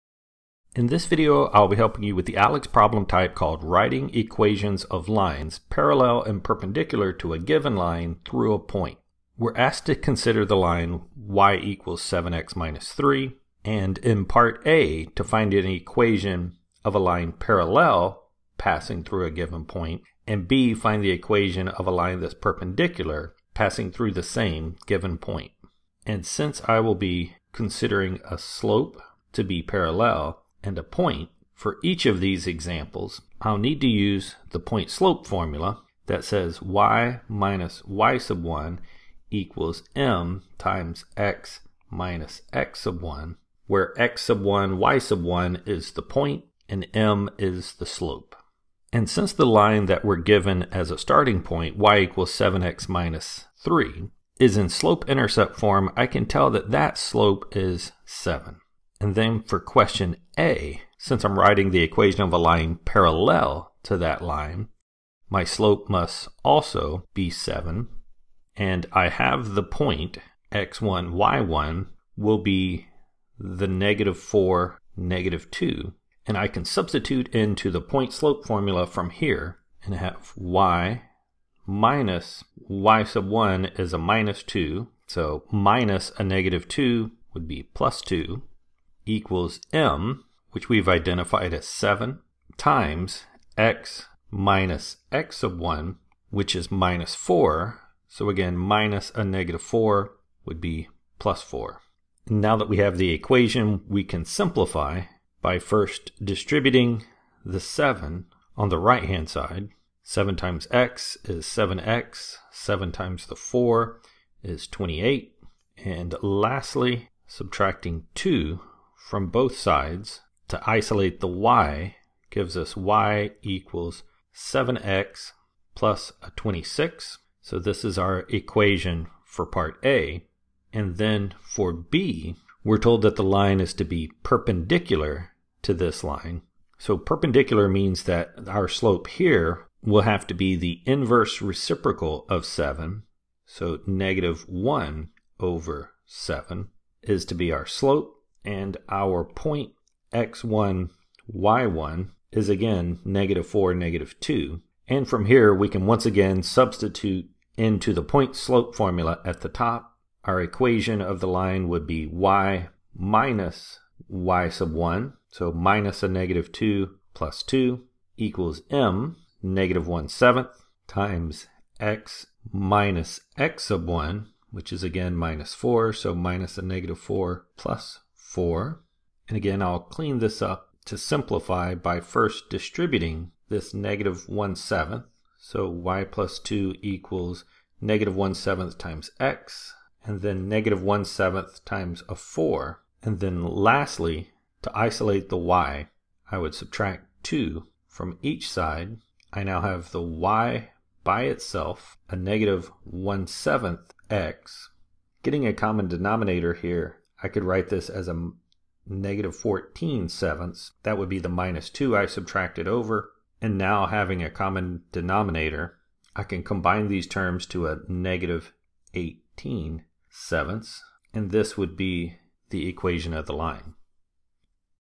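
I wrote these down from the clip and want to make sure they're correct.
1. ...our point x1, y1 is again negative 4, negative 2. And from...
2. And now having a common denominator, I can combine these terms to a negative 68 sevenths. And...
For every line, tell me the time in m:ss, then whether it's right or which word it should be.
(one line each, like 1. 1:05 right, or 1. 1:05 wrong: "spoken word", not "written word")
1. 2:28 right
2. 3:33 wrong: "18", not "68".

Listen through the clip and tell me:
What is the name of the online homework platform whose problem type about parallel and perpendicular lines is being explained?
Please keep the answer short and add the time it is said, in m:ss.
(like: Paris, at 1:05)
ALEKS, at 0:02.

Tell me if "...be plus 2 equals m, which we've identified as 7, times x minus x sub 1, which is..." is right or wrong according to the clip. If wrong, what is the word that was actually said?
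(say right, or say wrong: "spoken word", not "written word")
right.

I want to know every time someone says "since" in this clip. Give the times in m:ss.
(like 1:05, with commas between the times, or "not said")
0:26, 0:49, 1:00.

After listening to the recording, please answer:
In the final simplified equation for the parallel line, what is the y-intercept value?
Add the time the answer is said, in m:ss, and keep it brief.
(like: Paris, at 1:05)
26, at 2:06.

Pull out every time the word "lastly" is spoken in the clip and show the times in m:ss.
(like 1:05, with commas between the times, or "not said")
1:56, 3:13.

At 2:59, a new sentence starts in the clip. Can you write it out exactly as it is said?
And again, I'll clean this up to simplify by first distributing this negative 1 7th.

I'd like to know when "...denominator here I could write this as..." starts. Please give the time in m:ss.
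3:25.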